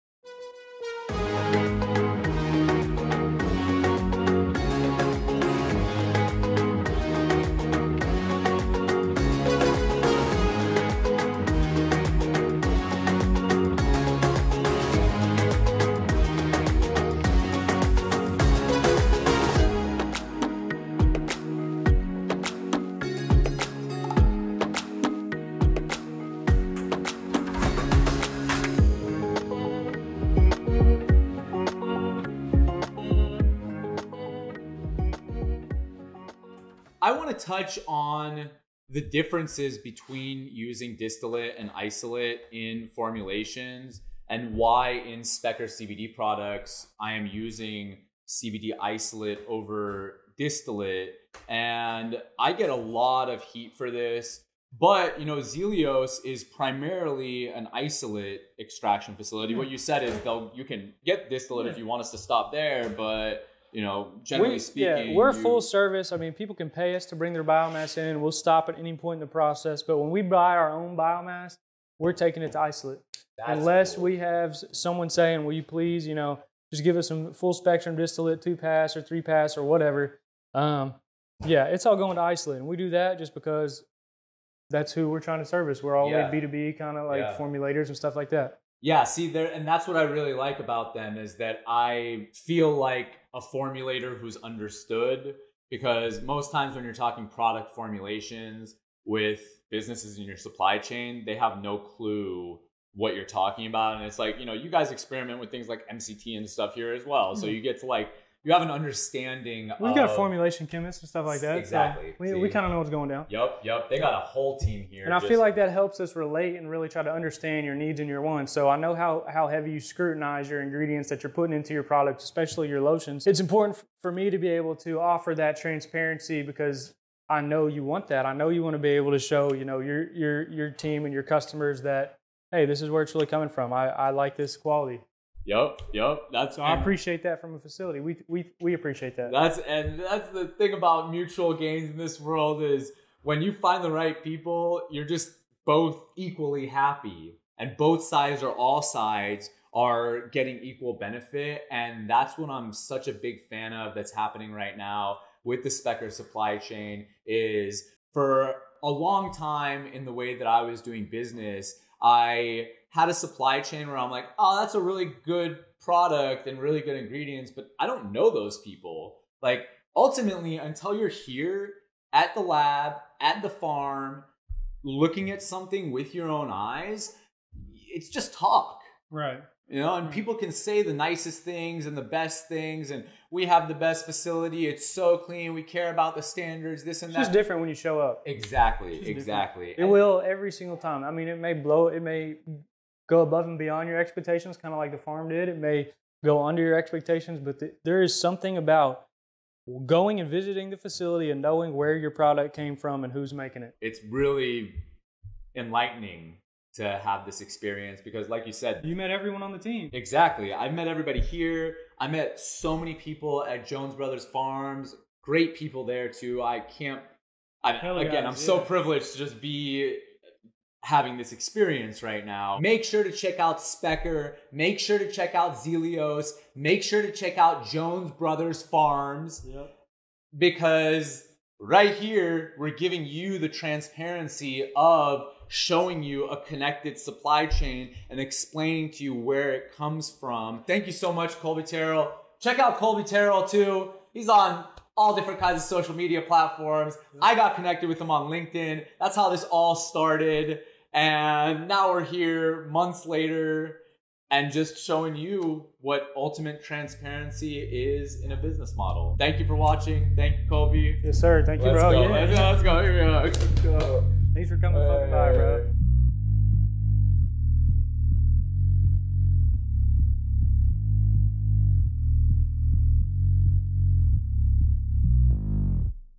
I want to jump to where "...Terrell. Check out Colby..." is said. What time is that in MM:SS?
04:01.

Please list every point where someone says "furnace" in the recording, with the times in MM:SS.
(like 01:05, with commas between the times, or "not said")
not said.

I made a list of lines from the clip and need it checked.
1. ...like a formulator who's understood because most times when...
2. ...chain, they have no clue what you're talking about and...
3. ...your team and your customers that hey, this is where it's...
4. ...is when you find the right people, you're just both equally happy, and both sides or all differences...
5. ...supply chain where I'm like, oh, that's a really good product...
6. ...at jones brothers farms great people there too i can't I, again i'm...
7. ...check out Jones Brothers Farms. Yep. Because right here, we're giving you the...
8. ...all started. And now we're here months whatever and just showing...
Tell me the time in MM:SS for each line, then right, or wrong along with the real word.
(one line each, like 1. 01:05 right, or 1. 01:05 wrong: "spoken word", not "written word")
1. 01:32 right
2. 01:40 right
3. 02:10 right
4. 02:22 wrong: "sides", not "differences"
5. 02:43 right
6. 03:33 right
7. 03:47 right
8. 04:09 wrong: "later", not "whatever".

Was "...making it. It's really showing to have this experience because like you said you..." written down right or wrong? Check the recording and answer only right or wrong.
wrong.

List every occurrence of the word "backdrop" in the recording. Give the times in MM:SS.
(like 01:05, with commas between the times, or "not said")
not said.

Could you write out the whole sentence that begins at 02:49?
Like ultimately, until you're here at the lab, at the farm, looking at something with your own eyes, it's just talk.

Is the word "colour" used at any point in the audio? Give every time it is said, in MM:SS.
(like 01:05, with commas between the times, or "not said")
not said.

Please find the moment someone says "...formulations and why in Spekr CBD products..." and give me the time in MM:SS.
00:42.